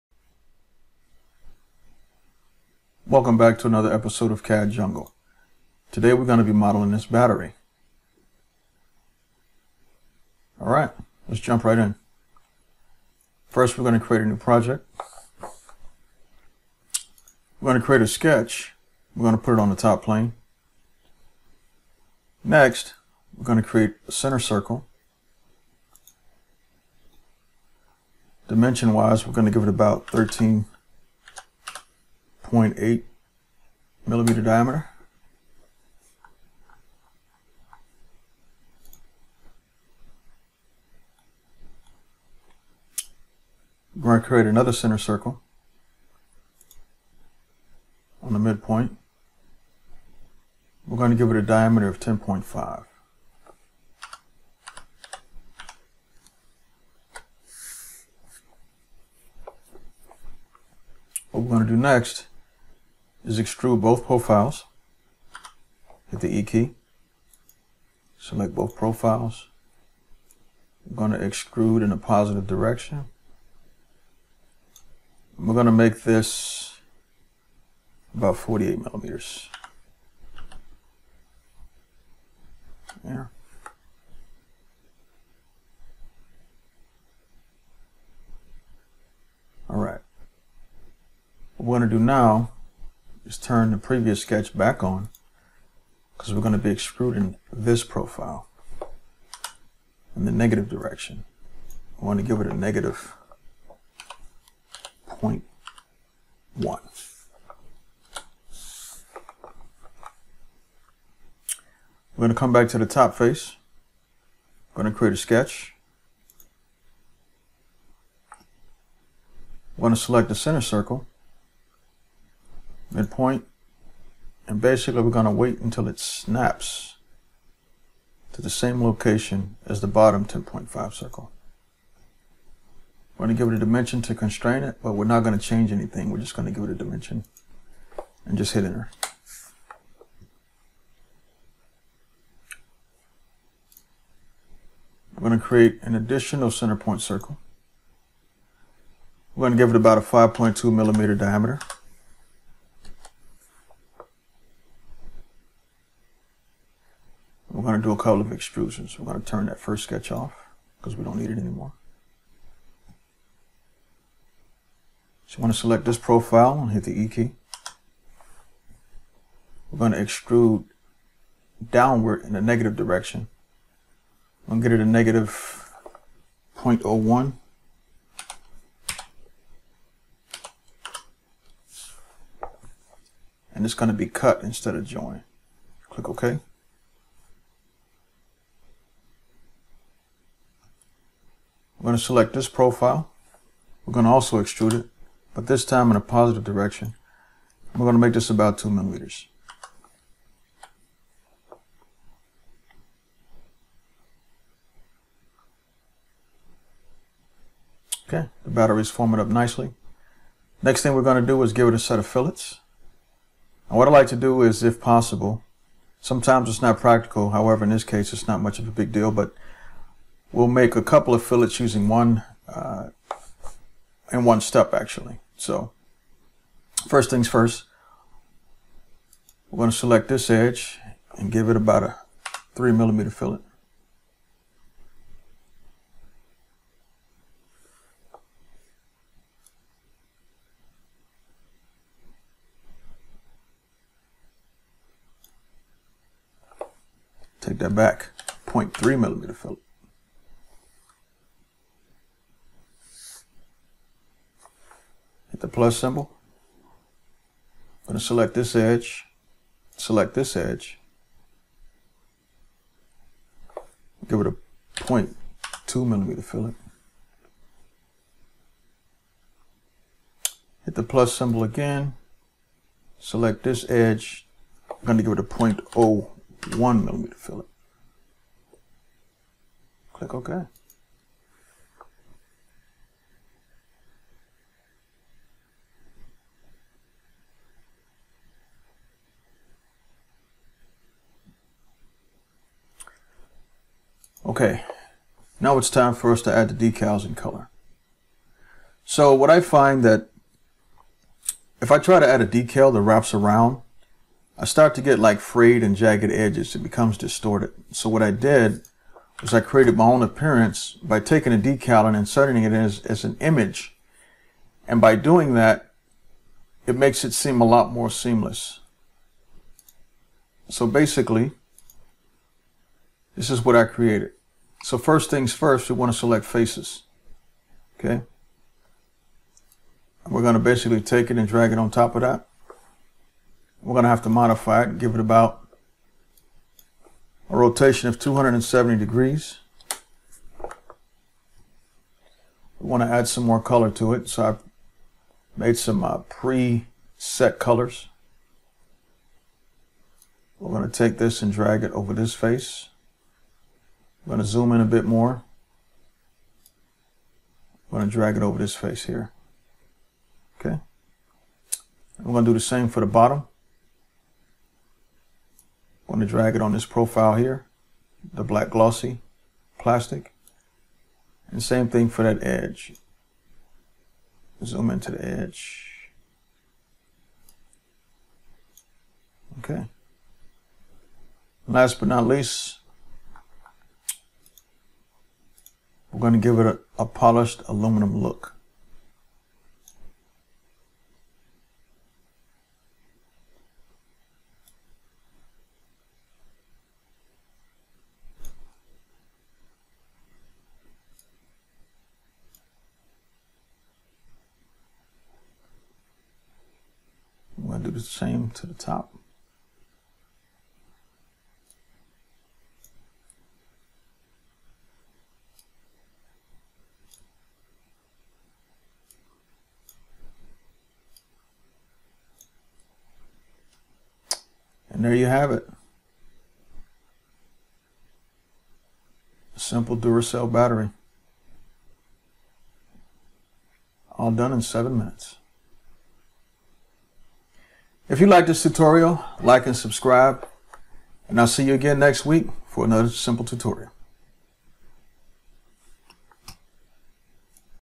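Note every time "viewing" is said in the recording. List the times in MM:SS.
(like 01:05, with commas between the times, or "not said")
not said.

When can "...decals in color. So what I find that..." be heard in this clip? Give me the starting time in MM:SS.
04:56.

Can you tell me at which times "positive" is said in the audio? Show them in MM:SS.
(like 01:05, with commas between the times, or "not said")
01:11, 03:16.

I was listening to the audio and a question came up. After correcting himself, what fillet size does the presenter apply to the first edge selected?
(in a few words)
0.3 millimeters.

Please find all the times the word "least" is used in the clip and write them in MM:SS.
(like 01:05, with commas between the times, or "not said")
06:22.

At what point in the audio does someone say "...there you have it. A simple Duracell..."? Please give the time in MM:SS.
07:04.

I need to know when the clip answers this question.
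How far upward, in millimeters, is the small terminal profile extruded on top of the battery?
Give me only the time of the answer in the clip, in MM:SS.
03:18.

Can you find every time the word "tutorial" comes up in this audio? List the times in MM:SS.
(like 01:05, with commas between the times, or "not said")
07:18, 07:23.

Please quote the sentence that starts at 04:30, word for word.
Hit the plus symbol again, select this edge, I'm going to give it a 0.01 millimeter fillet.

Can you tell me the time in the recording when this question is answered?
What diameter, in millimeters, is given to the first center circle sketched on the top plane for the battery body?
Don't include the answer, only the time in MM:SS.
00:30.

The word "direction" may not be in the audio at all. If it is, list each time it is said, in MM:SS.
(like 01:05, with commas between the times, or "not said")
01:12, 01:40, 02:52, 03:16.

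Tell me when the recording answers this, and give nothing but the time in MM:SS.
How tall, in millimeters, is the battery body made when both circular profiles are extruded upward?
01:18.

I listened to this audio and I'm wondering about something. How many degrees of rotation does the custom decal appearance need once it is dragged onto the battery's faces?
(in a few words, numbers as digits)
270 degrees.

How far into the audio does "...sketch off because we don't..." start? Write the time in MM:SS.
02:39.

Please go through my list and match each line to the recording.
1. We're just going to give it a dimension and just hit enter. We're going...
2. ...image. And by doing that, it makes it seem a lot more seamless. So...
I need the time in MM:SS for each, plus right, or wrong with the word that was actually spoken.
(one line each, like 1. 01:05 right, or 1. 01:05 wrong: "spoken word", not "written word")
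1. 02:16 right
2. 05:13 right.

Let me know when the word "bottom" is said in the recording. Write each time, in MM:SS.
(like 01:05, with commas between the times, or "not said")
02:09, 06:02.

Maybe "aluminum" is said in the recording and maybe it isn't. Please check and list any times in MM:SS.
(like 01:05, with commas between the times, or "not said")
06:27.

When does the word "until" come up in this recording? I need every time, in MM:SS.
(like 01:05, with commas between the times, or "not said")
02:05.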